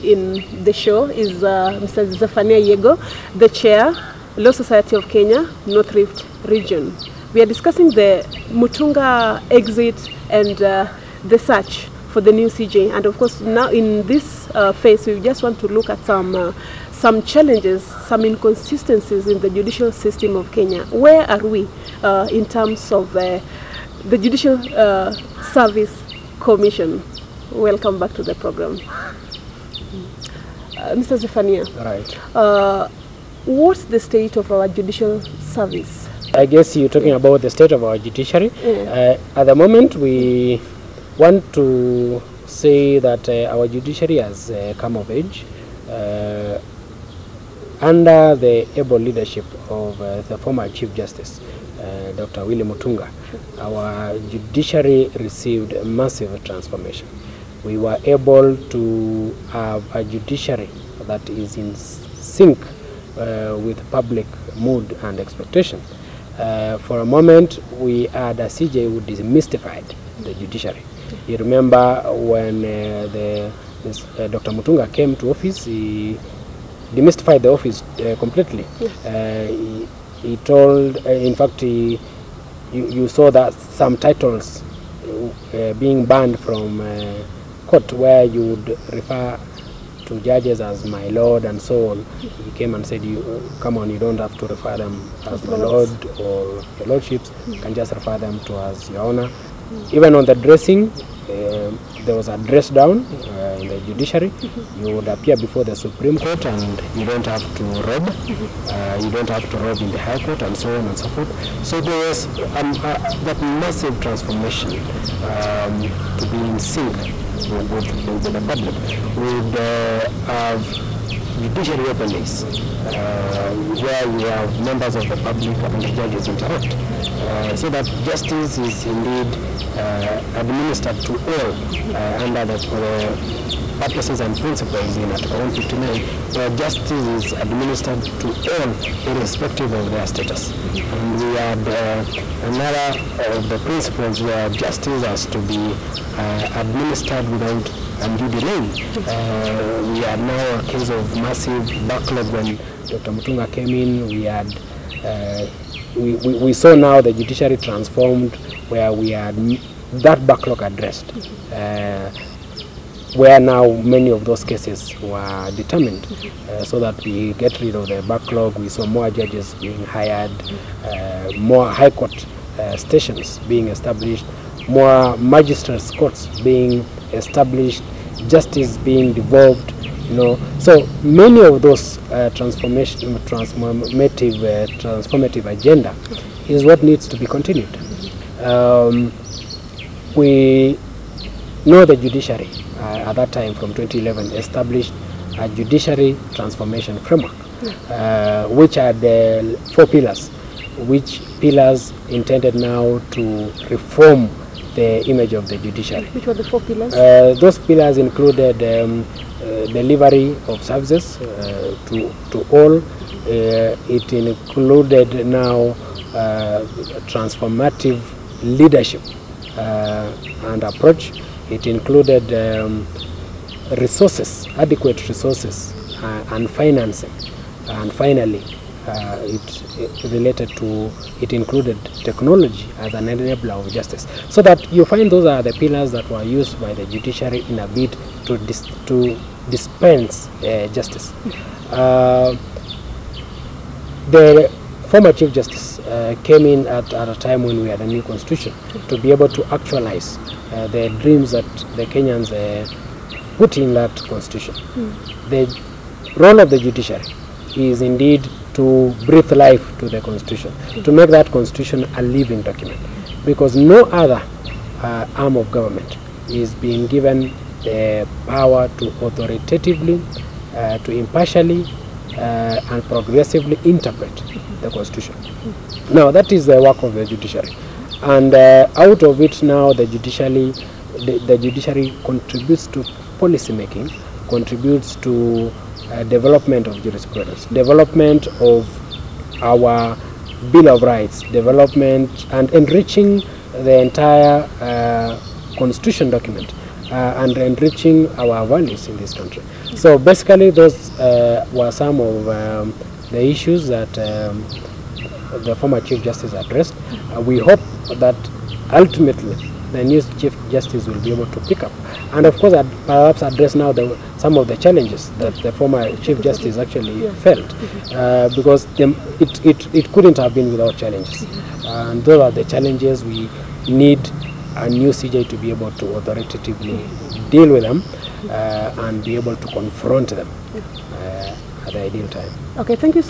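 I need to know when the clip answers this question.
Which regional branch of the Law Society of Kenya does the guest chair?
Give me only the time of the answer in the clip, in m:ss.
0:05.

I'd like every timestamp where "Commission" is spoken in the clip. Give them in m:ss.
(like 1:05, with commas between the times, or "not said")
0:26.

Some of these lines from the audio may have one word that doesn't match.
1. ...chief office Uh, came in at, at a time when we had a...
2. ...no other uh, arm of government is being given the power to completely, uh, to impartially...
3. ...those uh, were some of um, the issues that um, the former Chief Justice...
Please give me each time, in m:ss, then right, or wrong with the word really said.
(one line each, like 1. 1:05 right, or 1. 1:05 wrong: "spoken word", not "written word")
1. 4:05 wrong: "justice", not "office"
2. 4:23 wrong: "authoritatively", not "completely"
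3. 5:00 right.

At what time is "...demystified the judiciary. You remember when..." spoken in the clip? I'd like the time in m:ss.
1:09.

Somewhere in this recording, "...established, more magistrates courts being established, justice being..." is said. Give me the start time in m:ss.
2:53.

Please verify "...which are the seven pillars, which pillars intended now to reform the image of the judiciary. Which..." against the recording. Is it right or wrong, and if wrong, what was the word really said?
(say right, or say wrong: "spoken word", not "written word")
wrong: "four", not "seven".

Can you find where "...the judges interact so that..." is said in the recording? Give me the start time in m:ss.
2:05.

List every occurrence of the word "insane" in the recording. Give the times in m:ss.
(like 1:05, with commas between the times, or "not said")
not said.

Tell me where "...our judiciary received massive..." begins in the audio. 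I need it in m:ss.
0:53.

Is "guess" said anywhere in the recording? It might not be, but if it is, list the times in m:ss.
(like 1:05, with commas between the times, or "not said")
0:36.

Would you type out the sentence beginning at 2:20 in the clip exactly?
And we had uh, another of the principles where justice has to be uh, administered without undue delay.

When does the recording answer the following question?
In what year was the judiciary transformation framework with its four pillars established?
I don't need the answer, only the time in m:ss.
3:13.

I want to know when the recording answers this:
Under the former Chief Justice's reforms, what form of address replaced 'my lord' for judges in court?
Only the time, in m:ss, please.
1:38.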